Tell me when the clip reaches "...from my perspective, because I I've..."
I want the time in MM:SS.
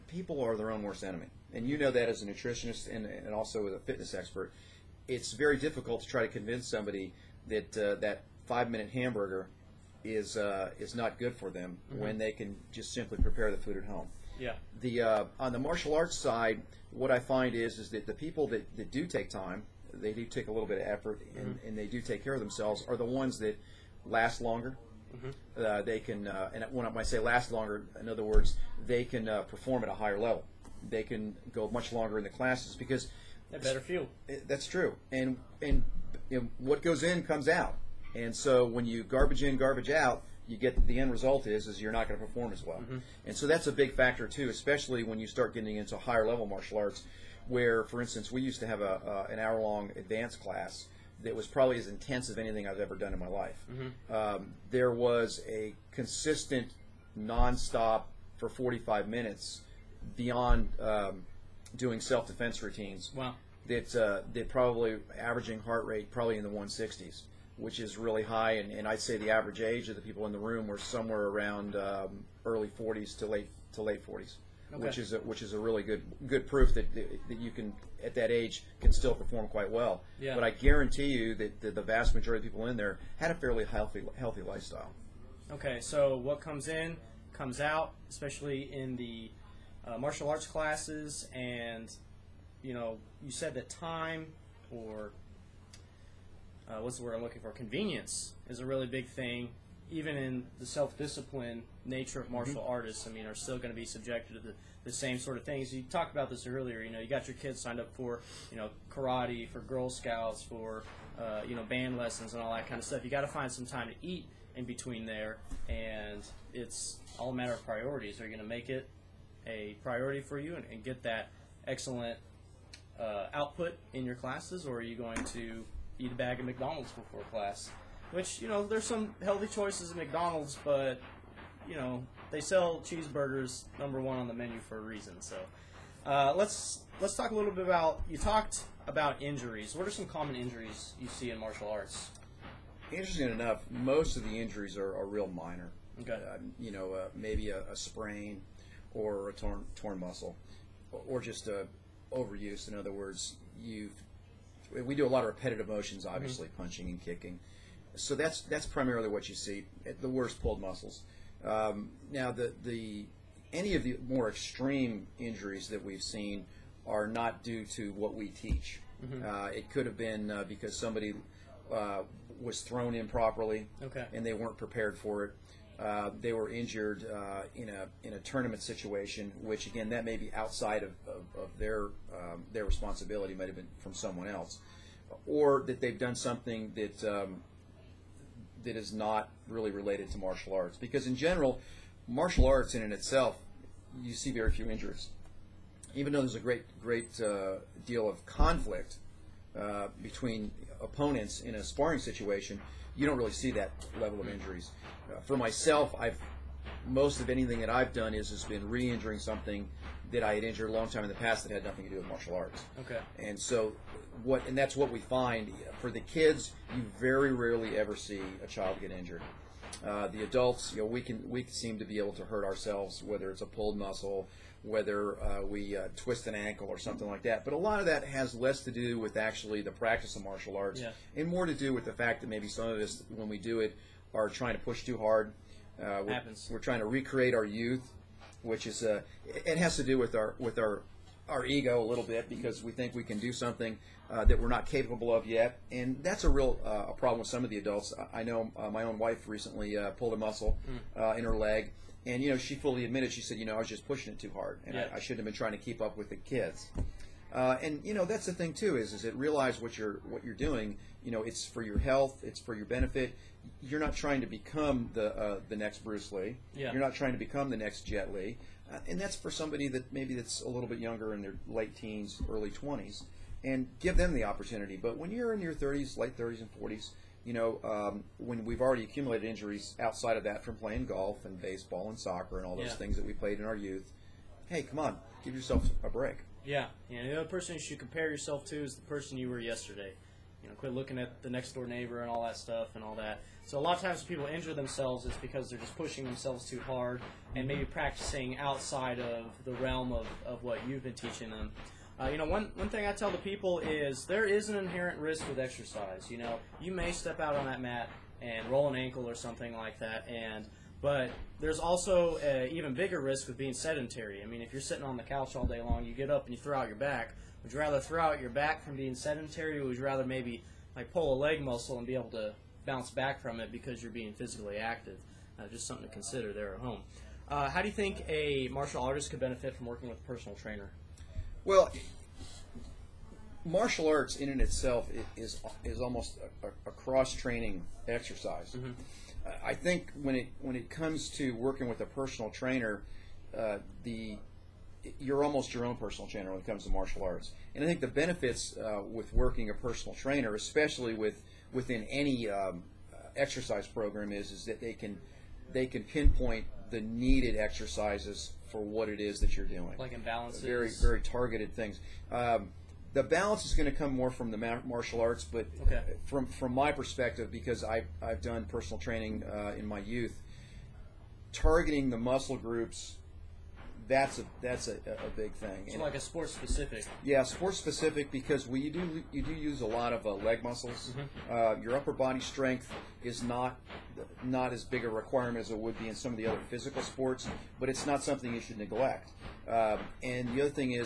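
06:06.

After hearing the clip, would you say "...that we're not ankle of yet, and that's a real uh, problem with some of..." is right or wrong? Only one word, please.
wrong.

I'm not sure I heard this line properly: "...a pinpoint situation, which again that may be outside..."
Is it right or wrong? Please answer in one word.
wrong.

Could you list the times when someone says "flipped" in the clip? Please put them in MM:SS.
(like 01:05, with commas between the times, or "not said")
not said.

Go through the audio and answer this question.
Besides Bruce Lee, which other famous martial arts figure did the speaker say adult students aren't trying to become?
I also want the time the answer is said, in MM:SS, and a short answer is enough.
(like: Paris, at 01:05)
Jet Li, at 04:27.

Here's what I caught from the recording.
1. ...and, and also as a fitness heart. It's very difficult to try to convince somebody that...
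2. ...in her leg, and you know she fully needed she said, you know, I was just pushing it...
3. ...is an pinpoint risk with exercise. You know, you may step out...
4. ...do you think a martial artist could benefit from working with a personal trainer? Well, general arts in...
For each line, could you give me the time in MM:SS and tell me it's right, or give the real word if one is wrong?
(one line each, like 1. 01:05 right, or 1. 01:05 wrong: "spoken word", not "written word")
1. 00:02 wrong: "expert", not "heart"
2. 04:11 wrong: "admitted", not "needed"
3. 05:04 wrong: "inherent", not "pinpoint"
4. 05:27 wrong: "martial", not "general".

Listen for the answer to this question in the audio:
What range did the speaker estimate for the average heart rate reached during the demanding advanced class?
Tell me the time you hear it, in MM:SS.
01:06.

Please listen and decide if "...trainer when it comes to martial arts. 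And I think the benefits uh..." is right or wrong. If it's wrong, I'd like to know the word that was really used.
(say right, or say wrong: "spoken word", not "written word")
right.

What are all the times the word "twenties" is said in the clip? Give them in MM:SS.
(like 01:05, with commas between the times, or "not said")
04:32.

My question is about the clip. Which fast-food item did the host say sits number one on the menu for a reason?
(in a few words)
cheeseburgers.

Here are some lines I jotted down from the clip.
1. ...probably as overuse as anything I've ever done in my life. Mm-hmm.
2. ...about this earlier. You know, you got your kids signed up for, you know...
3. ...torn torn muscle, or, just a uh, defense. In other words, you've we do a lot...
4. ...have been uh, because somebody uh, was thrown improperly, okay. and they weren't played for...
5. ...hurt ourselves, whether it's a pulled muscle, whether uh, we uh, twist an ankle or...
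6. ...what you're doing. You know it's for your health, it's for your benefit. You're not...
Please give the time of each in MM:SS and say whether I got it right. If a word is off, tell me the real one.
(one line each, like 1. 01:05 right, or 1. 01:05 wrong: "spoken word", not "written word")
1. 00:51 wrong: "intense", not "overuse"
2. 01:46 right
3. 02:29 wrong: "overuse", not "defense"
4. 02:49 wrong: "prepared", not "played"
5. 03:42 right
6. 04:20 right.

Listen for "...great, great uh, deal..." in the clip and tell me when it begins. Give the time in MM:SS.
03:16.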